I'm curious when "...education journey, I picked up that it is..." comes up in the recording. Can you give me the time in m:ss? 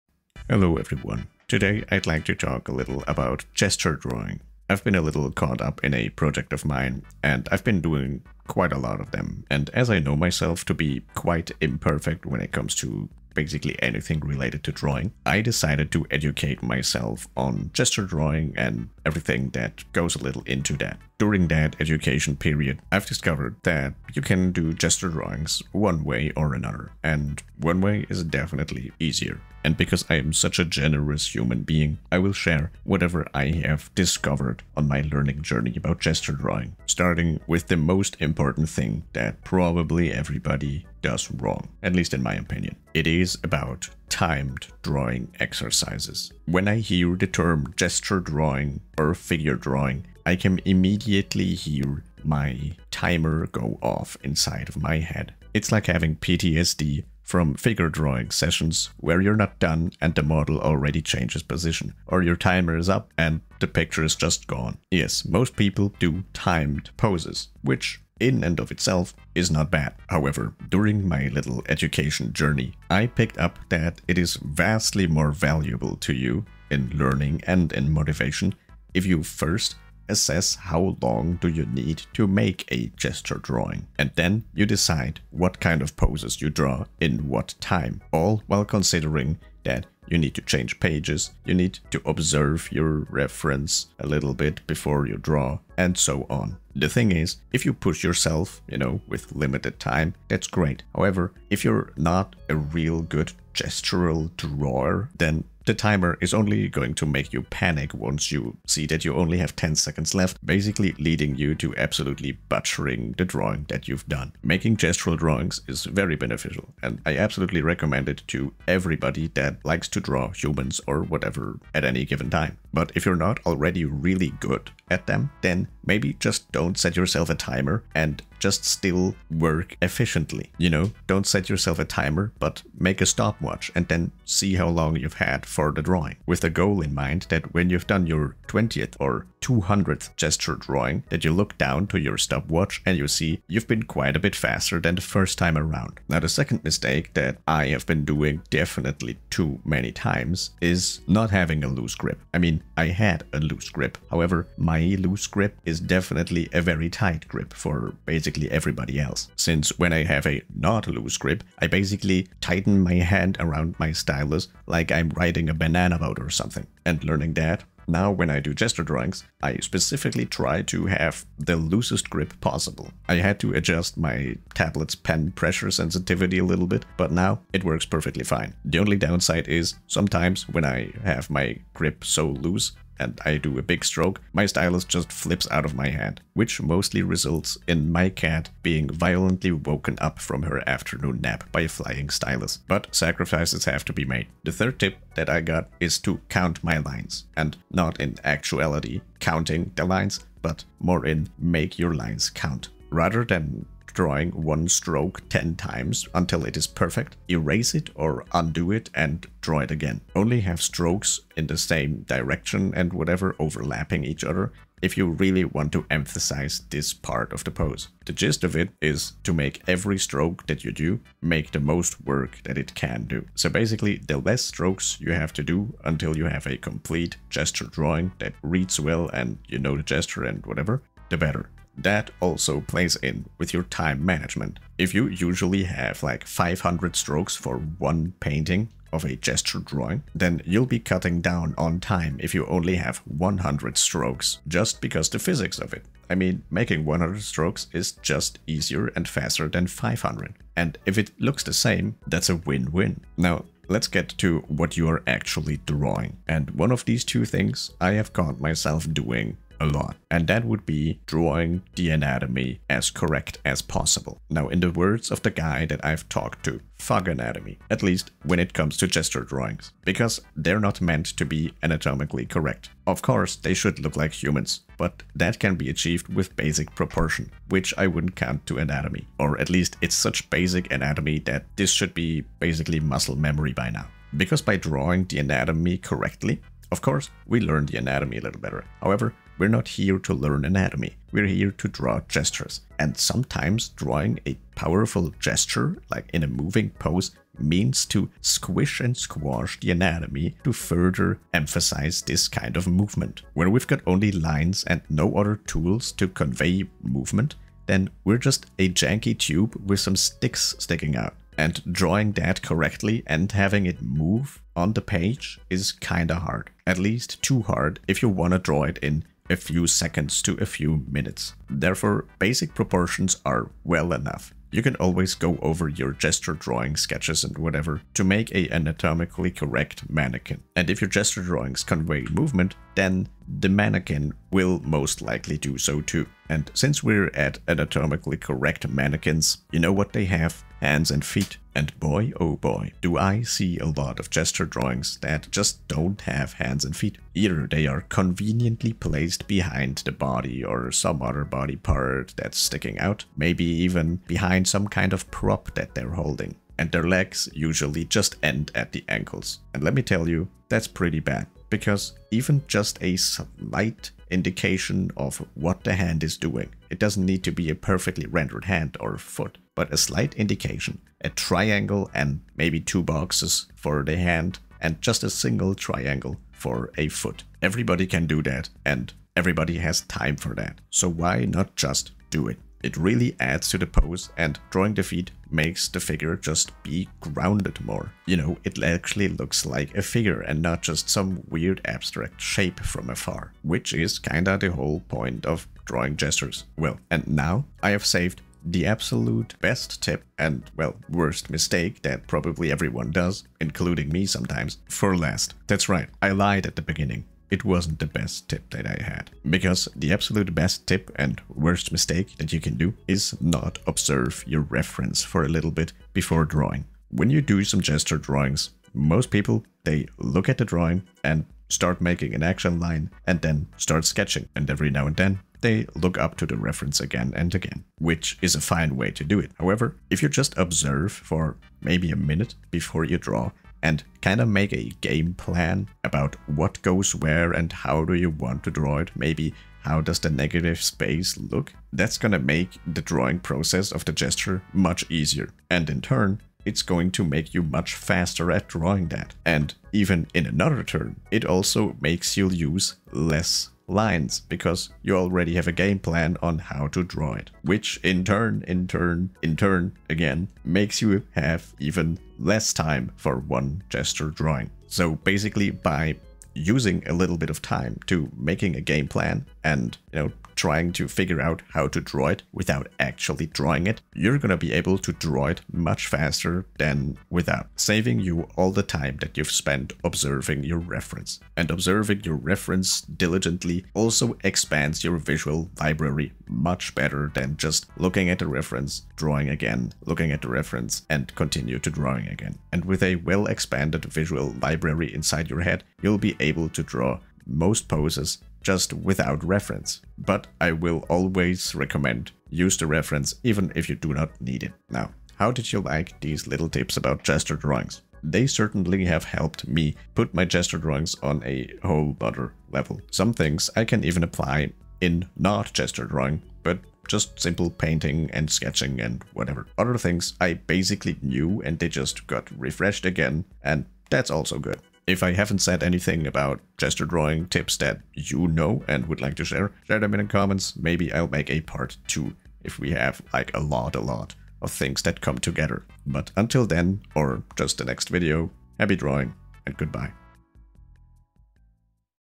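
1:11.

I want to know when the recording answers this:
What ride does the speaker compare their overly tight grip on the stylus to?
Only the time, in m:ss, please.
2:45.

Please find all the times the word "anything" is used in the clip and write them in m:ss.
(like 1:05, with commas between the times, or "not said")
0:13, 8:45.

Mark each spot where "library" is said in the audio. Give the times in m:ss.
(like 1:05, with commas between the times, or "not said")
8:05, 8:14.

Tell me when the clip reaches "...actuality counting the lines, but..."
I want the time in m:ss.
3:18.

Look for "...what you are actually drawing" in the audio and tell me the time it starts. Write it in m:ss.
4:14.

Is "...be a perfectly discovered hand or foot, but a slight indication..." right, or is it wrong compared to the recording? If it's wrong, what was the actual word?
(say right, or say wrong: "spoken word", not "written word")
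wrong: "rendered", not "discovered".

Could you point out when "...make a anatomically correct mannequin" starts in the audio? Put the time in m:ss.
5:28.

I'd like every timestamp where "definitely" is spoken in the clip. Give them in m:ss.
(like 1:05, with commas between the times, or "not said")
0:28, 2:28, 2:35.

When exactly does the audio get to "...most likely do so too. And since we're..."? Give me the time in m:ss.
5:34.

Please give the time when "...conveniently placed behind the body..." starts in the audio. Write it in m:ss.
5:47.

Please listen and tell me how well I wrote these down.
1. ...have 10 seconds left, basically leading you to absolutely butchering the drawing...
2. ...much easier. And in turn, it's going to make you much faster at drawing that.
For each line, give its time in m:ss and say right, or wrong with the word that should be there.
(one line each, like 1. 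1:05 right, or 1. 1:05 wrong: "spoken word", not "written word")
1. 1:49 right
2. 7:24 right.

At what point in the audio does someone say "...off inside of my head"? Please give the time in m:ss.
0:53.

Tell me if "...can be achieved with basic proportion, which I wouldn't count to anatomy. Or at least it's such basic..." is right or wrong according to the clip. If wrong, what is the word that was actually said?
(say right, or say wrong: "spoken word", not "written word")
right.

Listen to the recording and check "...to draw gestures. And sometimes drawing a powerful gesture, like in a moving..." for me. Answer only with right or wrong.
right.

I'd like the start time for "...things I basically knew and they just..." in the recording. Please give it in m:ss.
8:39.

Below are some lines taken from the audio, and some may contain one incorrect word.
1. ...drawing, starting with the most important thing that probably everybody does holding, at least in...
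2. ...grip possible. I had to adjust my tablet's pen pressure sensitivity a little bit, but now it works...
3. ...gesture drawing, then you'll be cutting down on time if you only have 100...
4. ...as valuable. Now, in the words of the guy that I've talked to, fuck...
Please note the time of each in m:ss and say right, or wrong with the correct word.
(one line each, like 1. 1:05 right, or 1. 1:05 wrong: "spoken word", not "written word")
1. 0:36 wrong: "wrong", not "holding"
2. 2:52 right
3. 3:59 right
4. 4:23 wrong: "possible", not "valuable".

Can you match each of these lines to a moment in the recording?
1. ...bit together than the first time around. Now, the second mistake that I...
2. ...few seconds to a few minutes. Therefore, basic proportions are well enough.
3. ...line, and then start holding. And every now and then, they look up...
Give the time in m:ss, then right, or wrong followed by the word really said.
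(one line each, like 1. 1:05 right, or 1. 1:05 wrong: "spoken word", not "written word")
1. 2:24 wrong: "faster", not "together"
2. 5:19 right
3. 7:02 wrong: "sketching", not "holding".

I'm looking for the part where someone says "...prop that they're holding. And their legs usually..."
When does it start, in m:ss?
5:55.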